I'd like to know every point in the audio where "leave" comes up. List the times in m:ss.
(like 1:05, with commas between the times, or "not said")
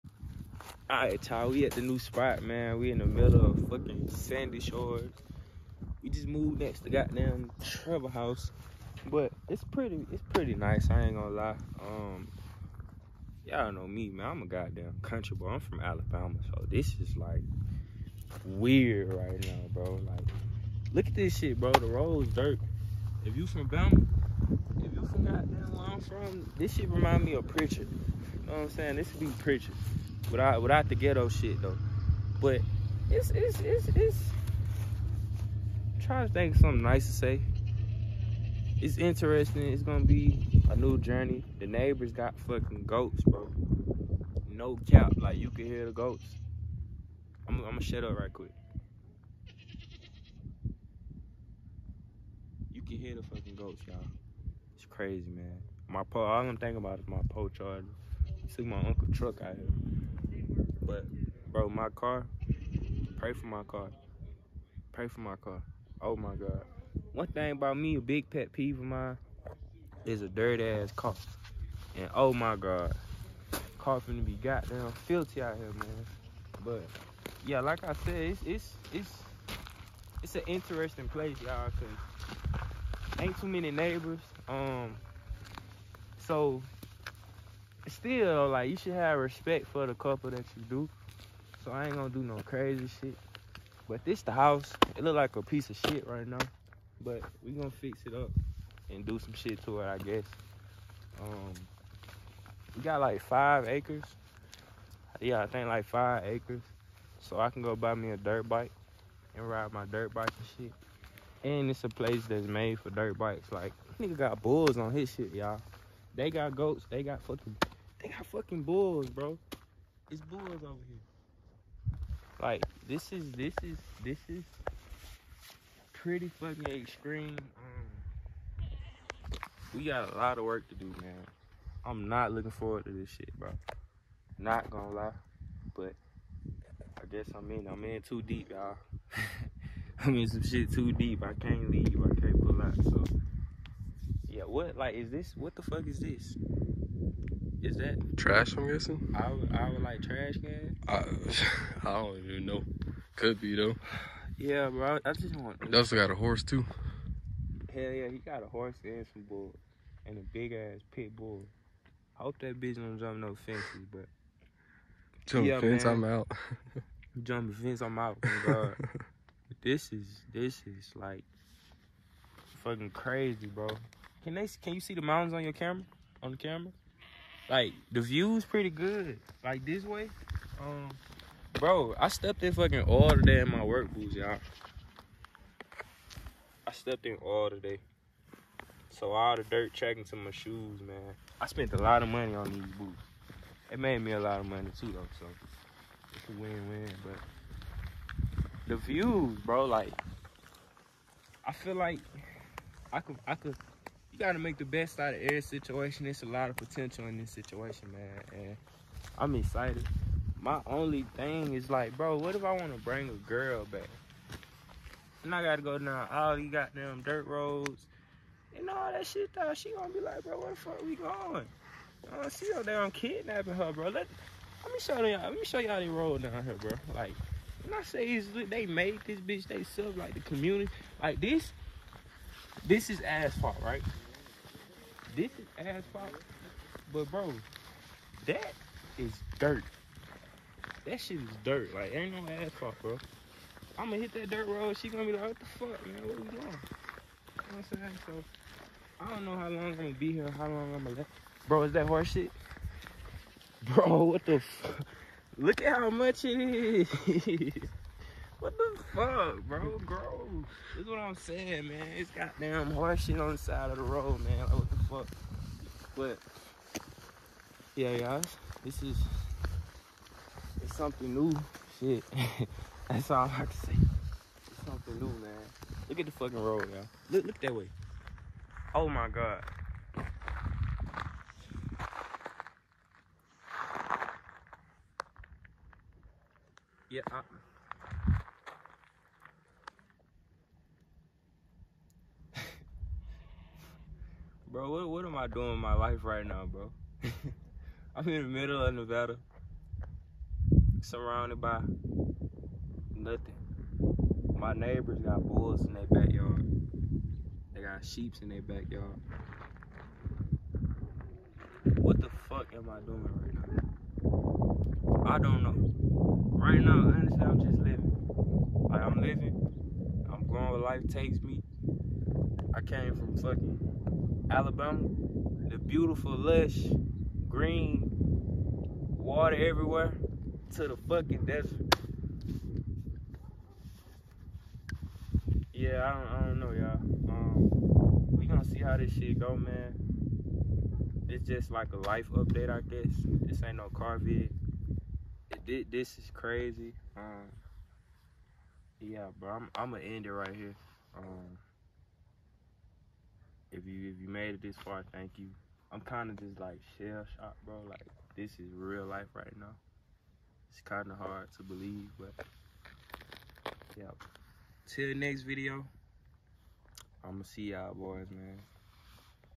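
2:21.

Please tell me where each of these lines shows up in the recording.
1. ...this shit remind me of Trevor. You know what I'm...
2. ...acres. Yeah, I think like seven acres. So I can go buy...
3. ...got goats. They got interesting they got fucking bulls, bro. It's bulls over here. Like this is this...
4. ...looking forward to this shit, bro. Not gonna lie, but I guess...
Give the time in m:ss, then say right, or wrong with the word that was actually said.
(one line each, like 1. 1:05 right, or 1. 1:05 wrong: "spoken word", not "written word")
1. 0:26 wrong: "Prichard", not "Trevor"
2. 1:43 wrong: "five", not "seven"
3. 1:56 wrong: "fucking", not "interesting"
4. 2:12 right.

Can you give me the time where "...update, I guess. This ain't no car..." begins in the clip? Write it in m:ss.
5:42.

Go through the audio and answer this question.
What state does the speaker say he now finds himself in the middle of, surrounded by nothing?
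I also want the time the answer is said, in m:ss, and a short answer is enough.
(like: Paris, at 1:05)
Nevada, at 4:58.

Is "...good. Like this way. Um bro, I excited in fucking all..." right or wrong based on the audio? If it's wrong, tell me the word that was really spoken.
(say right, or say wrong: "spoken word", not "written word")
wrong: "stepped", not "excited".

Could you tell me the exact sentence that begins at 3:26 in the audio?
It's a lot of potential in this situation, man.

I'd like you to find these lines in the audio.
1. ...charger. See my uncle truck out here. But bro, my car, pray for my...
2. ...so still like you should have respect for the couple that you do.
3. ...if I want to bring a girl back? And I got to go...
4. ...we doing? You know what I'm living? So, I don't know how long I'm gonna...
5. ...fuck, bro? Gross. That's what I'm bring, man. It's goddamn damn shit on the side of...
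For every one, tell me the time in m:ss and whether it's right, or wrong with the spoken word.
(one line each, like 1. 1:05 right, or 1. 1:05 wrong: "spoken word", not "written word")
1. 0:57 right
2. 1:26 right
3. 3:32 right
4. 4:06 wrong: "saying", not "living"
5. 4:18 wrong: "saying", not "bring".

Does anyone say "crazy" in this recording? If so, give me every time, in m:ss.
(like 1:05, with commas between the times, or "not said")
0:54, 1:32, 2:52, 5:46.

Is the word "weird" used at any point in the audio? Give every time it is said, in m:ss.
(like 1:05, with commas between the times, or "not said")
0:18.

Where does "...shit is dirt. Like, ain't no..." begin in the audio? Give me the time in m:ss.
4:01.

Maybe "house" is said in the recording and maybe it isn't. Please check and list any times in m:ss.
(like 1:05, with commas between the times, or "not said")
0:08, 1:34.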